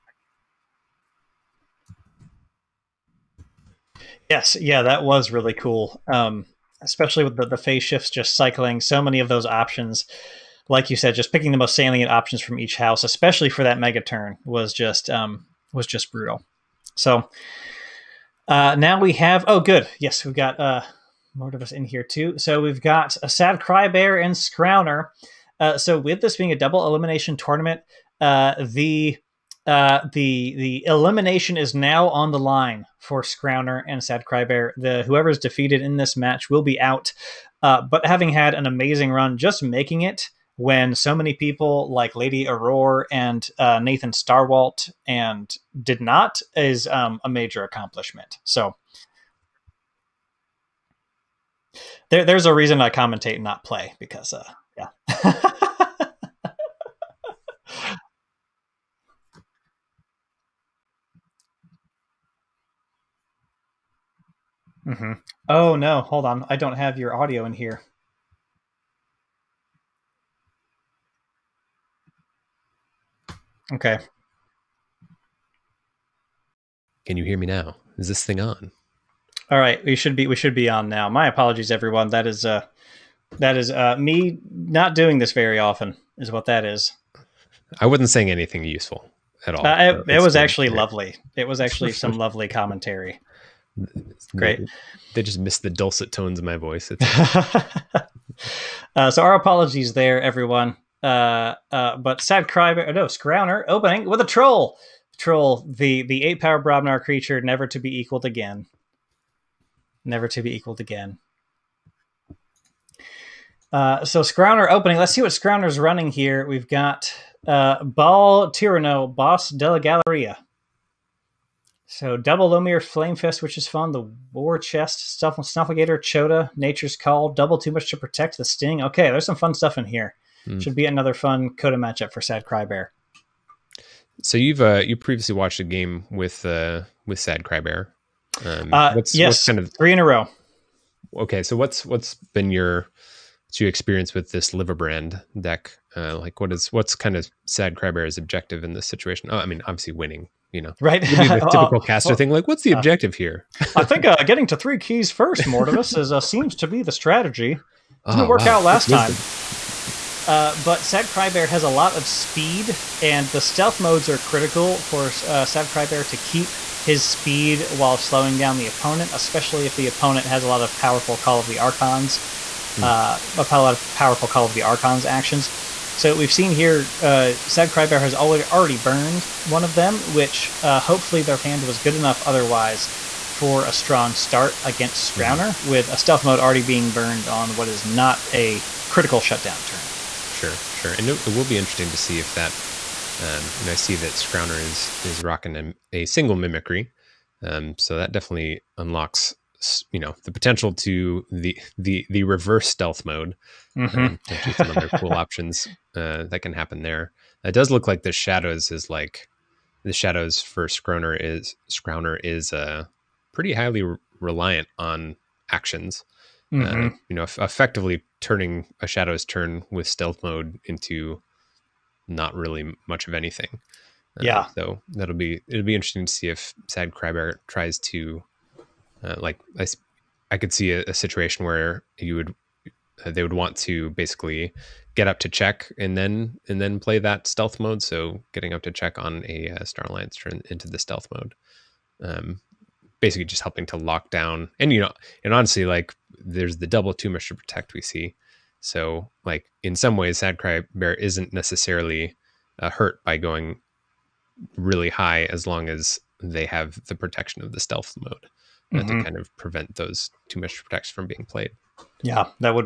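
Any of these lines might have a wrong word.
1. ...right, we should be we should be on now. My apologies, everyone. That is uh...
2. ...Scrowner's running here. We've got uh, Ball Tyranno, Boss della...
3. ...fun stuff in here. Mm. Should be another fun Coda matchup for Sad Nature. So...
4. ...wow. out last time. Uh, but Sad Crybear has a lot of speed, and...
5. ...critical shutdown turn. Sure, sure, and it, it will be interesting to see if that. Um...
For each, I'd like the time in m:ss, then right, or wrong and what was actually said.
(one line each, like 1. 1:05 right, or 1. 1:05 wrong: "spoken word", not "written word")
1. 1:19 right
2. 1:55 right
3. 2:09 wrong: "Crybear", not "Nature"
4. 2:38 right
5. 3:08 right.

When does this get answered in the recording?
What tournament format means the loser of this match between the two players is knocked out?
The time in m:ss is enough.
0:26.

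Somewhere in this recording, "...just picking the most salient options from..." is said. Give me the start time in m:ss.
0:11.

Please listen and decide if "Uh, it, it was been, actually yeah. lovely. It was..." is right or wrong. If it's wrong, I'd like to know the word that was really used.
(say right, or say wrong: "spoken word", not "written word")
right.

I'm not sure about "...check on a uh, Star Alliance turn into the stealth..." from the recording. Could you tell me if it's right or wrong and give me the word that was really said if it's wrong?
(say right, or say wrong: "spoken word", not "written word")
right.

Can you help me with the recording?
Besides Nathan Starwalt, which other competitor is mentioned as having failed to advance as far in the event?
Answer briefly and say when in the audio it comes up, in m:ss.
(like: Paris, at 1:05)
Lady Aurora, at 0:42.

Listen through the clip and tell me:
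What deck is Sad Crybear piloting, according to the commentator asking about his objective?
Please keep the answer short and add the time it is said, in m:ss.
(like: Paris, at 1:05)
Liverbrand, at 2:24.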